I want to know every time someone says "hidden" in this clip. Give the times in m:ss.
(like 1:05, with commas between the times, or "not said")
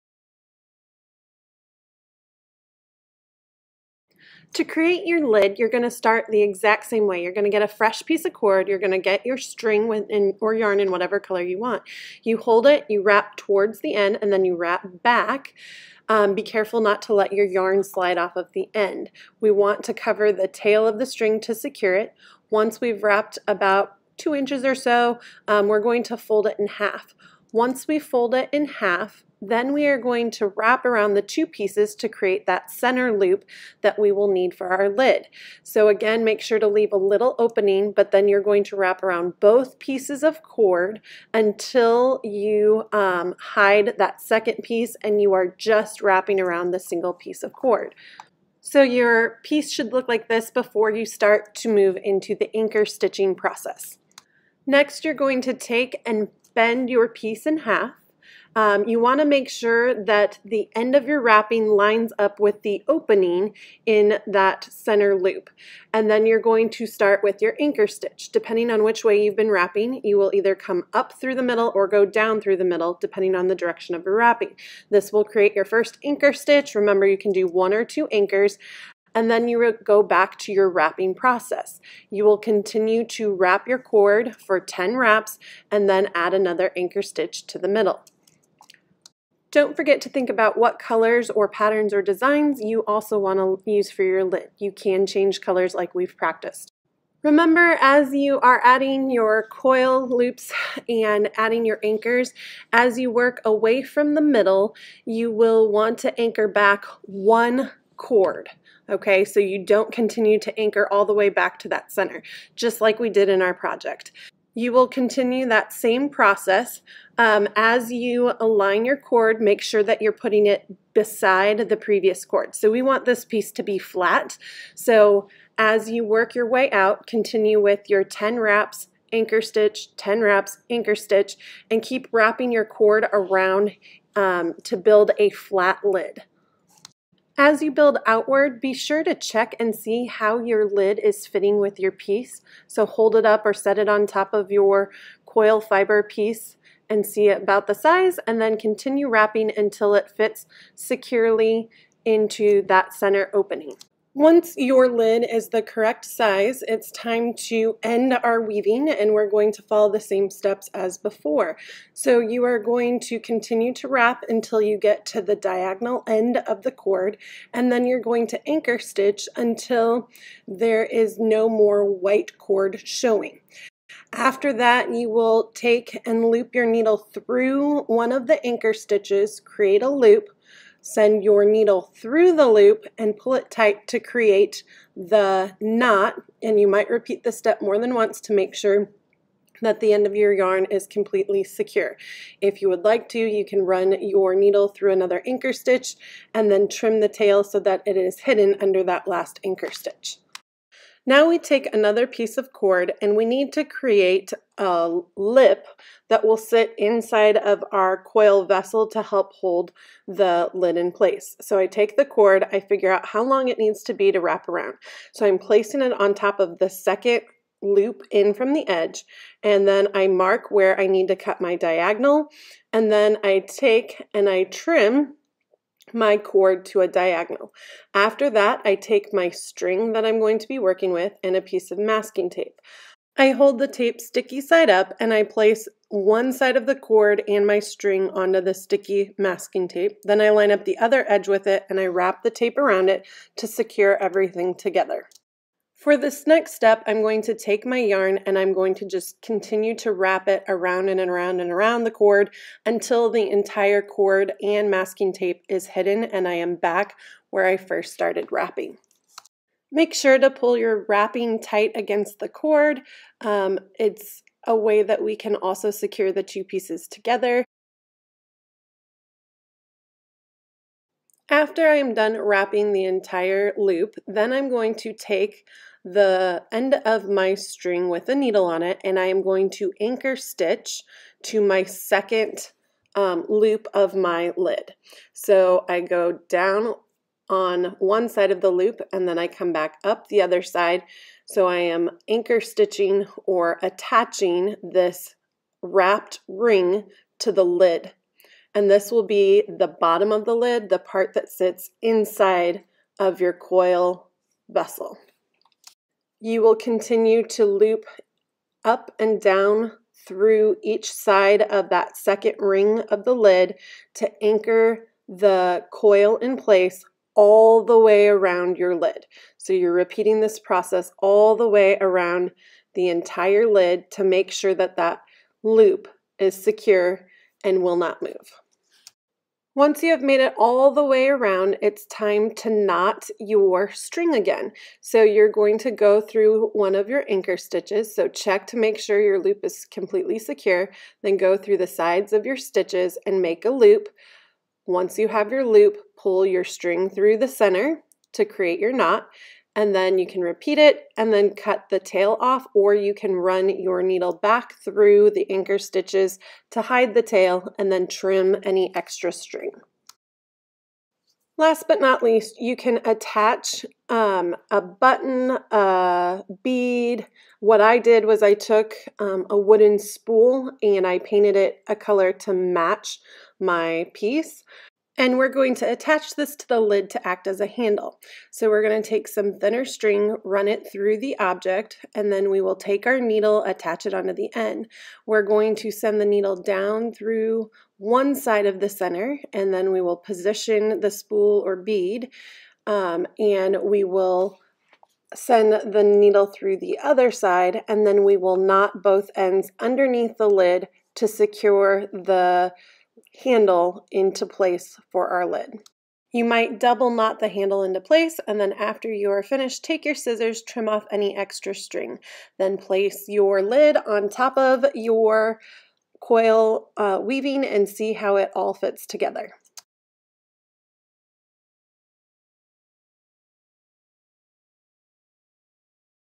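3:18, 4:15.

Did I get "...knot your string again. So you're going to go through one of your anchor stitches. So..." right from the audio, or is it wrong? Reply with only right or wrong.
right.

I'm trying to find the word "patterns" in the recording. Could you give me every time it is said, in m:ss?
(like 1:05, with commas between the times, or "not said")
1:31.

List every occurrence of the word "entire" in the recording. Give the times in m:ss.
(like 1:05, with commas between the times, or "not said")
4:13, 4:32, 5:22.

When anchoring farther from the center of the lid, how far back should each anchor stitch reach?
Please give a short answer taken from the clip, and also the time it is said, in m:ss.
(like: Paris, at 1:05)
one cord, at 1:46.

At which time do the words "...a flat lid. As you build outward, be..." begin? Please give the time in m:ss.
2:15.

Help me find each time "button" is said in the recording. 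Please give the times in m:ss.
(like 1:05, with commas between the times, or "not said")
6:04.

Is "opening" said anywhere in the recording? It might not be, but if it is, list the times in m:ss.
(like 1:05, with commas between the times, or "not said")
0:37, 1:02, 2:33.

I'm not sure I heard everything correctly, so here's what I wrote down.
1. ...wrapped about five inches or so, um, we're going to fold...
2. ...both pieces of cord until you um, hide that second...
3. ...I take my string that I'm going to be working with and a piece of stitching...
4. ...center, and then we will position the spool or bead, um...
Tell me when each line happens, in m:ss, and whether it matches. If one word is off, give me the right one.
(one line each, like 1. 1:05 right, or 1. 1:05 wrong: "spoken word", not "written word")
1. 0:23 wrong: "two", not "five"
2. 0:39 right
3. 3:48 wrong: "masking", not "stitching"
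4. 6:28 right.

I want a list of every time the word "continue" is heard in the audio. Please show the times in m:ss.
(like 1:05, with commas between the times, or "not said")
1:22, 1:49, 1:54, 2:07, 2:28, 2:43, 4:09, 5:06.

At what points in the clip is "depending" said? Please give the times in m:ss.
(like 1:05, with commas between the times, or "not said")
1:08, 1:12.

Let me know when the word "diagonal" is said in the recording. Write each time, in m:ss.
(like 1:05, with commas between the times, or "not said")
2:45, 3:41, 3:46.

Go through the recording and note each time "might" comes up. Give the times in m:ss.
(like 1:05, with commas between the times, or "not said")
3:06, 6:46.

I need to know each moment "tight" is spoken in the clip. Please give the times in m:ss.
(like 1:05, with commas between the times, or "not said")
3:03, 4:21.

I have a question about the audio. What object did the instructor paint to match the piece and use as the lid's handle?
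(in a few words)
a wooden spool.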